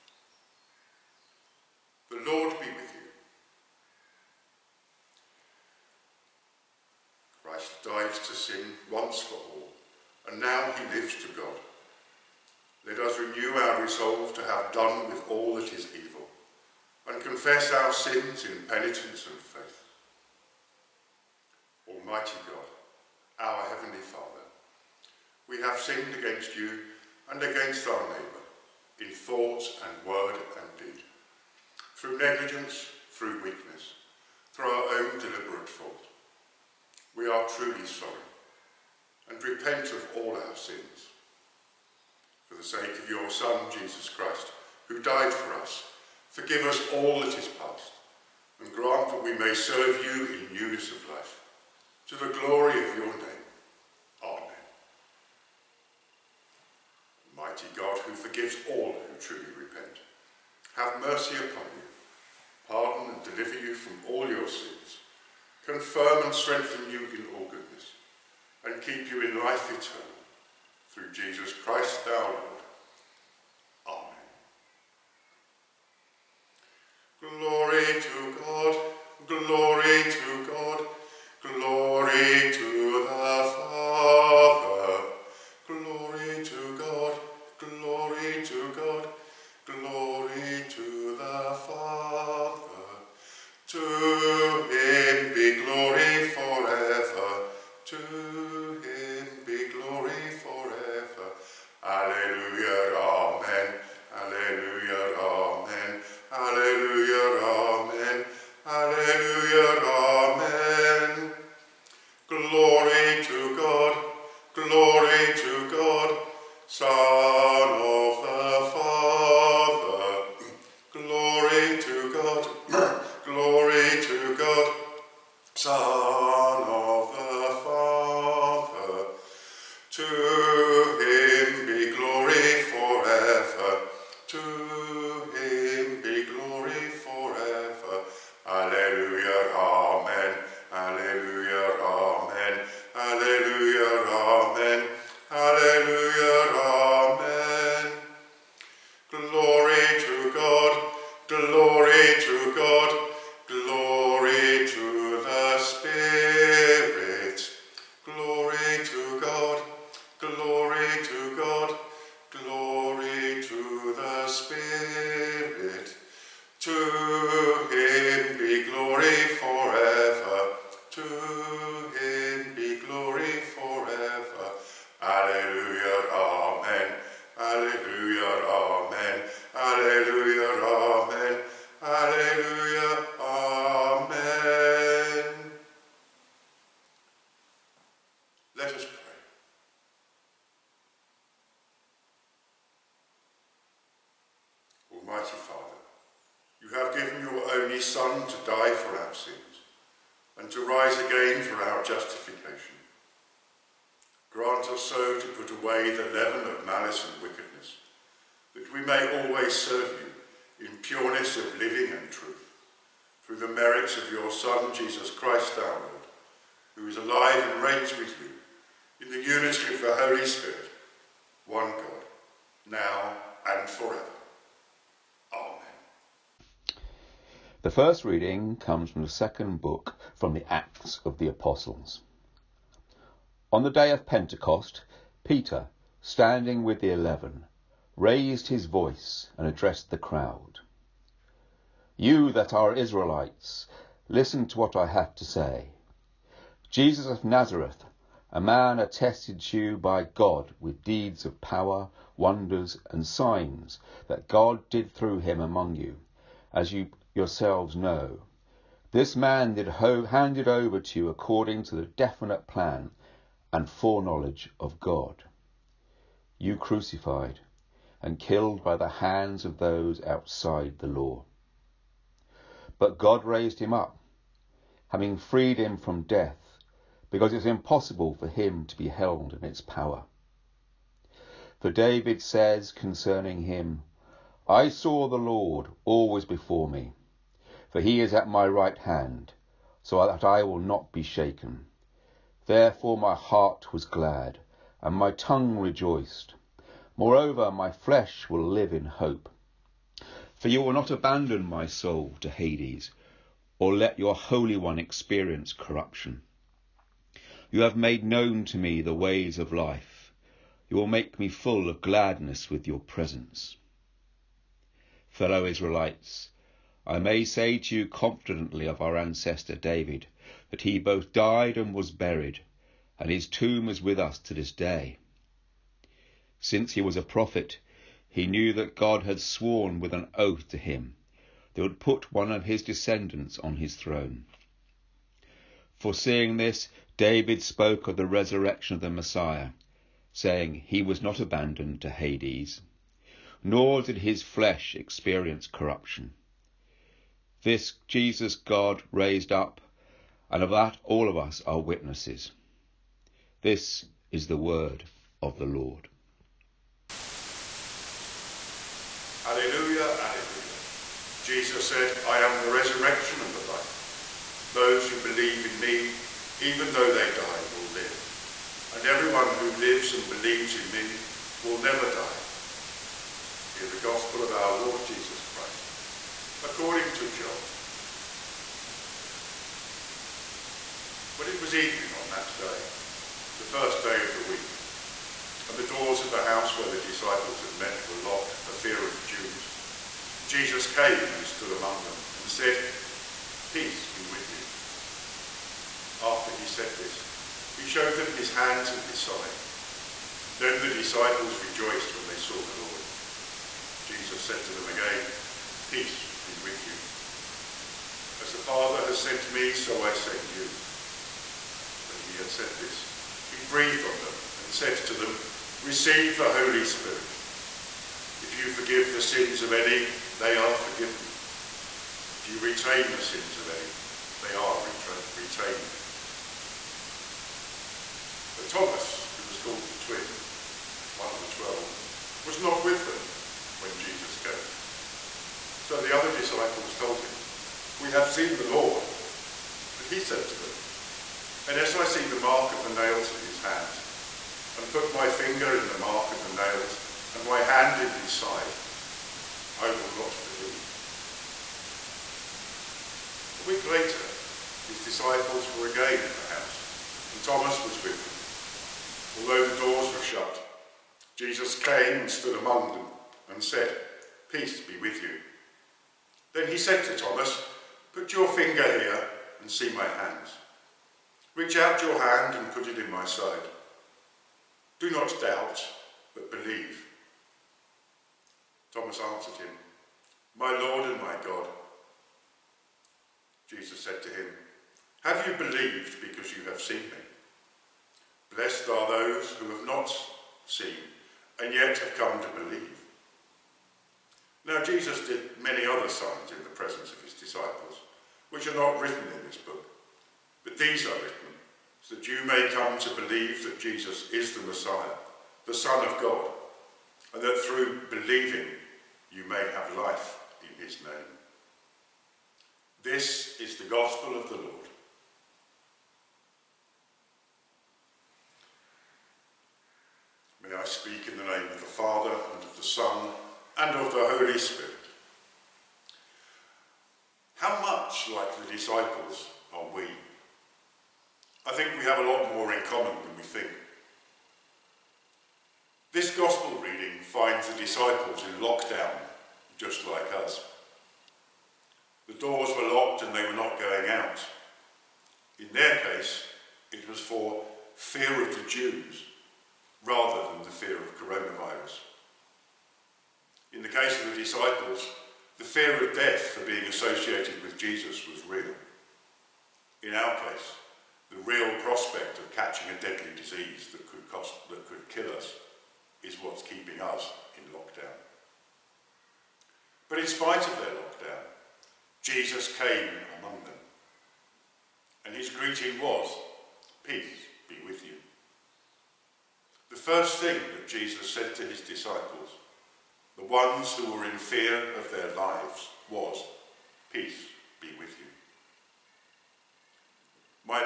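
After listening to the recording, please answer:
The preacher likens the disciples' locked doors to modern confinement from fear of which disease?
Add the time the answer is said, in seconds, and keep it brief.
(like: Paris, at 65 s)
Coronavirus, at 550 s.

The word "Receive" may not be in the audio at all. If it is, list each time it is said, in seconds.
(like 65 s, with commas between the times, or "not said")
415 s.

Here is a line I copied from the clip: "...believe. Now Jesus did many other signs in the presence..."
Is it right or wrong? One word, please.
right.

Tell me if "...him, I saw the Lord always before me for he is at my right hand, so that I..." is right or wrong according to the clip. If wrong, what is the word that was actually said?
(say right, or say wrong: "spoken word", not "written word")
right.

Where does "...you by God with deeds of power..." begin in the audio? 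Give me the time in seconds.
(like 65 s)
249 s.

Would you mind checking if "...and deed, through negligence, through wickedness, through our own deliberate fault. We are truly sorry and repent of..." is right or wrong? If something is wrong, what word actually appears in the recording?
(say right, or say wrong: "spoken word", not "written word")
wrong: "weakness", not "wickedness".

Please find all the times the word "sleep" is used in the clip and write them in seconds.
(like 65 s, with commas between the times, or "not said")
not said.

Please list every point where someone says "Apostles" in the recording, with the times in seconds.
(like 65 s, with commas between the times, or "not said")
231 s.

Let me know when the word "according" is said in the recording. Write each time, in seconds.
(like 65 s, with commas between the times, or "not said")
261 s, 376 s.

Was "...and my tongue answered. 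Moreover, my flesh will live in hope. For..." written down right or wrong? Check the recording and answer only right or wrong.
wrong.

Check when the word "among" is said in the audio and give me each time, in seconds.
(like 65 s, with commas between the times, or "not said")
255 s, 391 s, 462 s, 573 s.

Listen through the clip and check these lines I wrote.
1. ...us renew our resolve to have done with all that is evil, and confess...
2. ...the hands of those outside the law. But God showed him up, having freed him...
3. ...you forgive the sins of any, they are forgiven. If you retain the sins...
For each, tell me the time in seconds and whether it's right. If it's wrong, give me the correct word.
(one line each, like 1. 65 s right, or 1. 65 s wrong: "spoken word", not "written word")
1. 13 s right
2. 268 s wrong: "raised", not "showed"
3. 418 s right.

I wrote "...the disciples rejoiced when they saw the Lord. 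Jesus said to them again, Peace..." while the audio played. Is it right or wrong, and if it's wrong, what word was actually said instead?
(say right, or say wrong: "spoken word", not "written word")
right.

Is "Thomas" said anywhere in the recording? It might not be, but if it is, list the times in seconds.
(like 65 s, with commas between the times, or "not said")
428 s, 457 s, 467 s, 478 s.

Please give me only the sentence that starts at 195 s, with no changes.
Almighty Father, you have given your only Son to die for our sins and to rise again for our justification.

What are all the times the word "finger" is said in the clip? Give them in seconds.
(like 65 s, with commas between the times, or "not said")
445 s, 468 s.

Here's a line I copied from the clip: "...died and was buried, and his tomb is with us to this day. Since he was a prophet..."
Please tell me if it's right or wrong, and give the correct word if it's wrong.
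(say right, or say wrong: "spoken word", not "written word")
right.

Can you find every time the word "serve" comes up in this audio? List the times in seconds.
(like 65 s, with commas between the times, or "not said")
49 s, 209 s.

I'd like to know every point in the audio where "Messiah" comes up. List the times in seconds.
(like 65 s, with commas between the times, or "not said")
338 s, 504 s.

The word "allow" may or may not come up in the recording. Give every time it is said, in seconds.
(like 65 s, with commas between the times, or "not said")
not said.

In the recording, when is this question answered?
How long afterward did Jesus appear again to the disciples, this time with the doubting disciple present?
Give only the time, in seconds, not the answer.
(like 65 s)
453 s.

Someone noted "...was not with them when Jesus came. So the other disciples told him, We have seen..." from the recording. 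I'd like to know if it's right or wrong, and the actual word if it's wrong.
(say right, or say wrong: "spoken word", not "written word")
right.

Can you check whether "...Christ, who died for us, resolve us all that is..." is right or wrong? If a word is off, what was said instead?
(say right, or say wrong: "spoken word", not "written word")
wrong: "forgive", not "resolve".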